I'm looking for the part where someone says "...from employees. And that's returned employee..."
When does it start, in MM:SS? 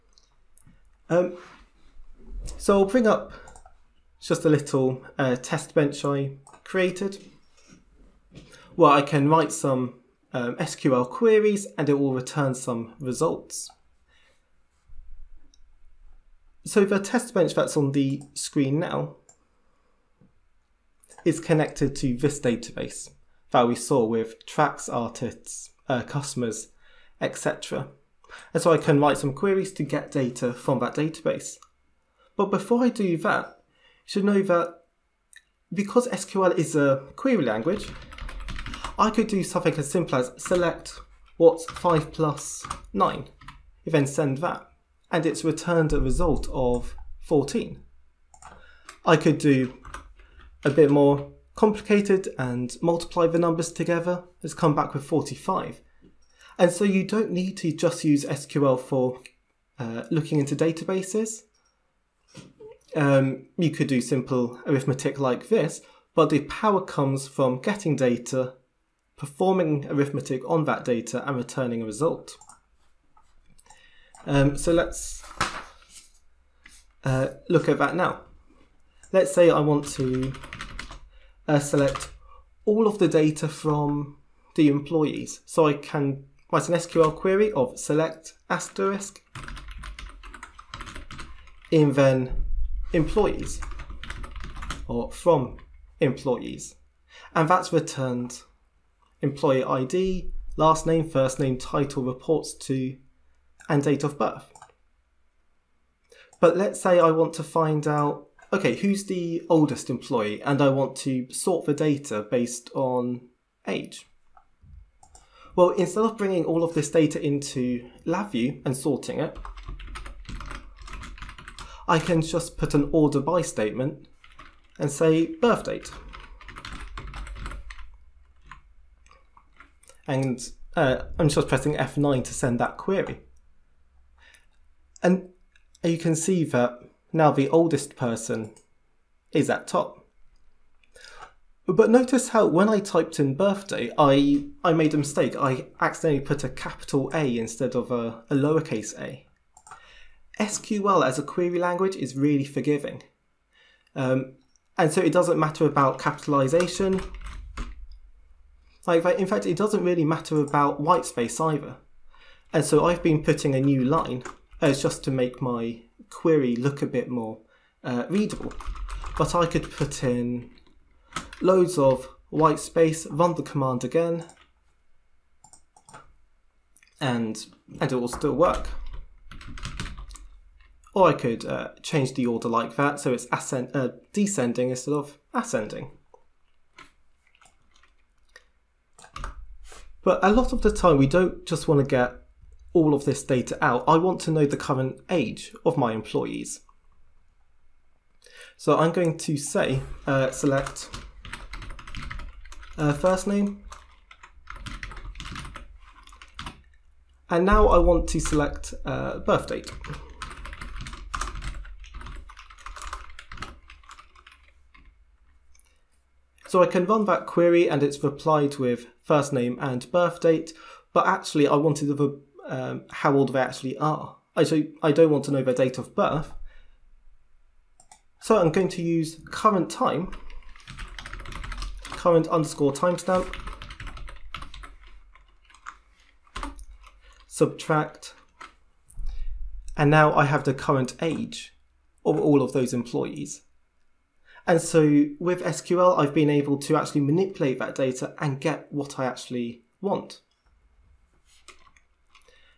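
01:35.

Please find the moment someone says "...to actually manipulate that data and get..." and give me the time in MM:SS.
04:06.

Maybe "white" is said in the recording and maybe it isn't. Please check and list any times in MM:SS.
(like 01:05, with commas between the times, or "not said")
02:40, 02:52.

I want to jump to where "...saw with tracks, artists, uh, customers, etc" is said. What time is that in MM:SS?
00:23.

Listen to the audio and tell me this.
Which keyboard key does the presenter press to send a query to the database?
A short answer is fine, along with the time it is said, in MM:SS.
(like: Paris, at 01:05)
F9, at 02:11.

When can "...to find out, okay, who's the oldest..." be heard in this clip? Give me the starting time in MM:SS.
01:47.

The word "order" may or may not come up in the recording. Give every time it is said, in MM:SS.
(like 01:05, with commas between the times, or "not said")
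02:02, 03:02.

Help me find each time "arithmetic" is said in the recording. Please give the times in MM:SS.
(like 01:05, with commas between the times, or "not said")
01:04, 01:09.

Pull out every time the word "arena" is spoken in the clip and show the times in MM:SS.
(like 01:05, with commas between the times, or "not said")
not said.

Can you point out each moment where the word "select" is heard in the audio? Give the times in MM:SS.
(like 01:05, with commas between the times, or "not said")
00:40, 01:21, 01:27, 03:20, 03:28.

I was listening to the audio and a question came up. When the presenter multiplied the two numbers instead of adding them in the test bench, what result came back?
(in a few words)
45.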